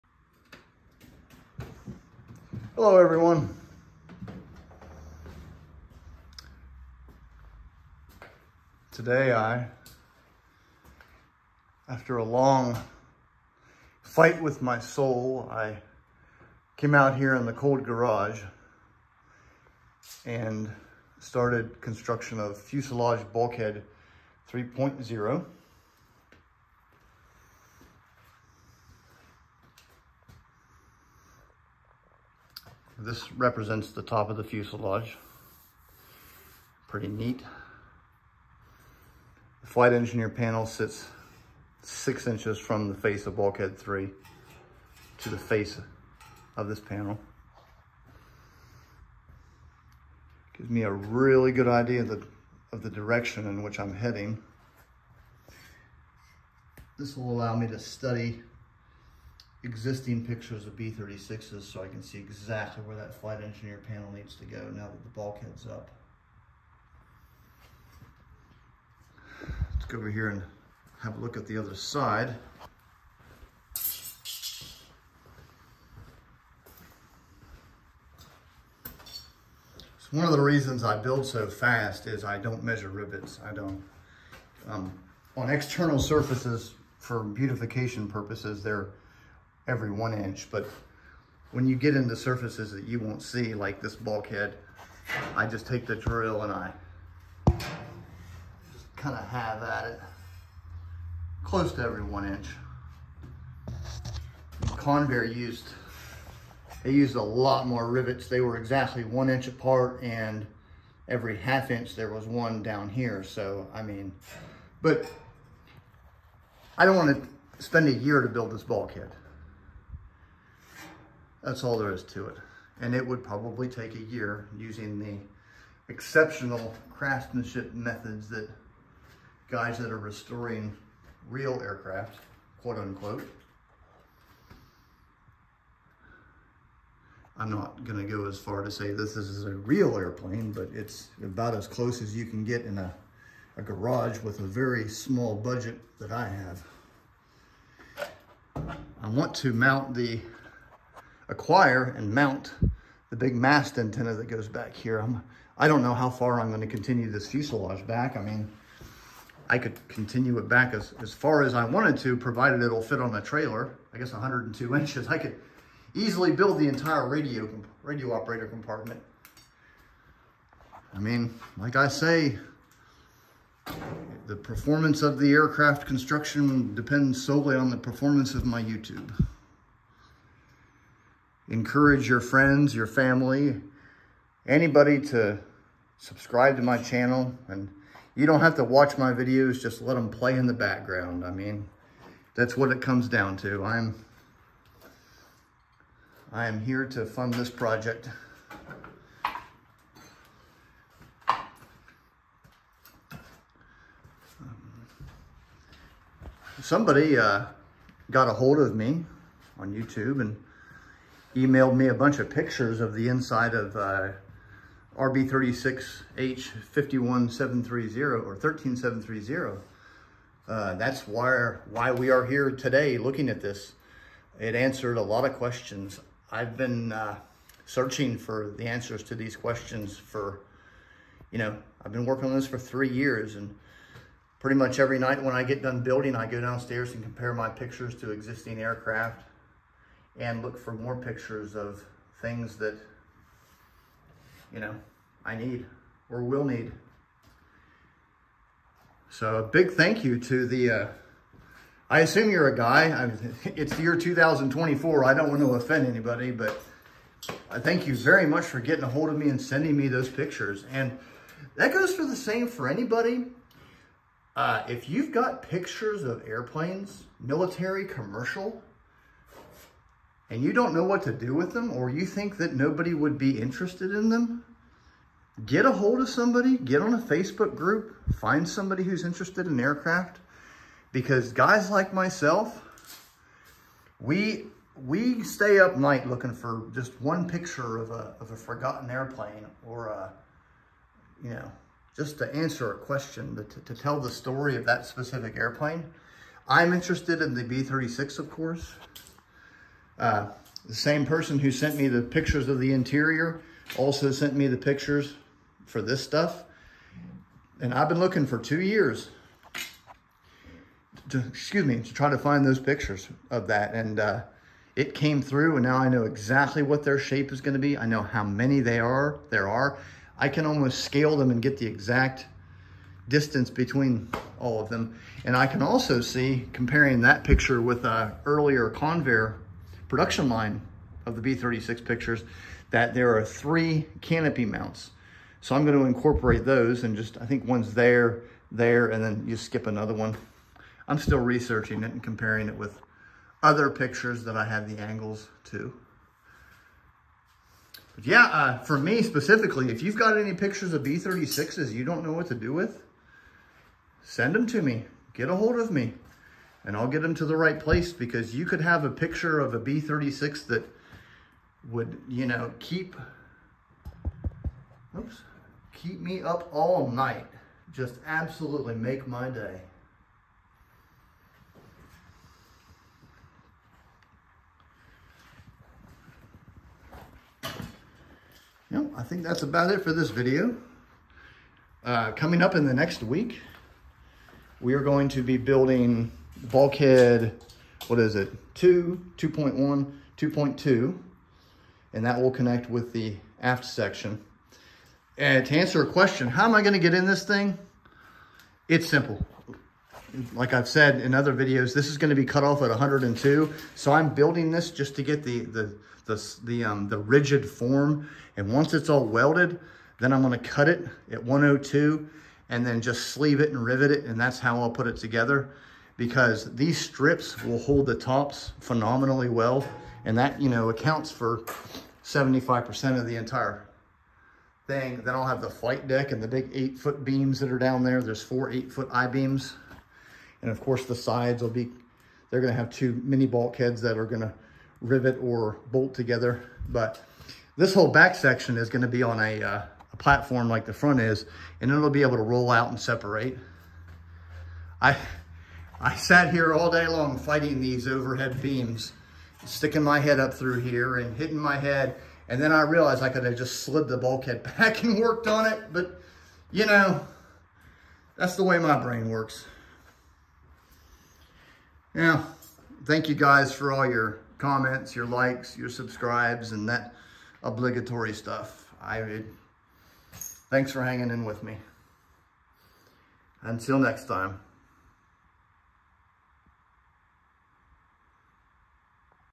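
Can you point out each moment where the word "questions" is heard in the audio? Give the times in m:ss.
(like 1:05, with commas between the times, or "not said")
3:45, 3:49, 4:52, 6:35.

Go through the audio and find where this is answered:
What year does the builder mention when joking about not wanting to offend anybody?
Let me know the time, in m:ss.
4:13.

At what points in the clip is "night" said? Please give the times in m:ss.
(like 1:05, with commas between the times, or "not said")
3:54, 4:45, 6:06.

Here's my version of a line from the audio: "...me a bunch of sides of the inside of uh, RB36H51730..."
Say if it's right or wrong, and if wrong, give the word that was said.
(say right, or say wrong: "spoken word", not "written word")
wrong: "pictures", not "sides".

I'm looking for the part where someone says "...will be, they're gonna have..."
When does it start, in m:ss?
7:11.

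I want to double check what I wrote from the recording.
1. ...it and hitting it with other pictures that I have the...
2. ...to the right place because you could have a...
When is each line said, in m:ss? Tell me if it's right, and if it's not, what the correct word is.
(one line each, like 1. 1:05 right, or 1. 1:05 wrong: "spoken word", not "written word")
1. 5:41 wrong: "comparing", not "hitting"
2. 5:57 right.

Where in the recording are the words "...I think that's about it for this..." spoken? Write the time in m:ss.
6:18.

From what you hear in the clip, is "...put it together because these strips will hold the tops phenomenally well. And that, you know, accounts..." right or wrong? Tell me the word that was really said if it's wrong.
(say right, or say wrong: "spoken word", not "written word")
right.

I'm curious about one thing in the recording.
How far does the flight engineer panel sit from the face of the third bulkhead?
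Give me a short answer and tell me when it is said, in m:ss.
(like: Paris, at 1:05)
6 inches, at 0:41.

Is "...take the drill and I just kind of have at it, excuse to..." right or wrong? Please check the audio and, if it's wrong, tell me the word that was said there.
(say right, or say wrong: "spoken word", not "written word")
wrong: "close", not "excuse".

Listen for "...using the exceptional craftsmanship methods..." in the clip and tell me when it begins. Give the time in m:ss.
2:04.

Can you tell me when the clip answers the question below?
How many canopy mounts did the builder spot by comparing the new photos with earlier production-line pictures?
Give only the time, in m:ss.
5:33.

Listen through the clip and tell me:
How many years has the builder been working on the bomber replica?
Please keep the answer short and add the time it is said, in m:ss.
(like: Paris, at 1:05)
3 years, at 3:52.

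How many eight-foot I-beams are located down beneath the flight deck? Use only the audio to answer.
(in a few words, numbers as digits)
4.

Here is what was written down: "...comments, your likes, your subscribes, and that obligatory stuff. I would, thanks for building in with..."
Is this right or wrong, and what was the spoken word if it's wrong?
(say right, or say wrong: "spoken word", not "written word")
wrong: "hanging", not "building".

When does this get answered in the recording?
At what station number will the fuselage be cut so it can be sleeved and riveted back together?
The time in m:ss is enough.
6:42.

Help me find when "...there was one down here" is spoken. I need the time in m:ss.
1:51.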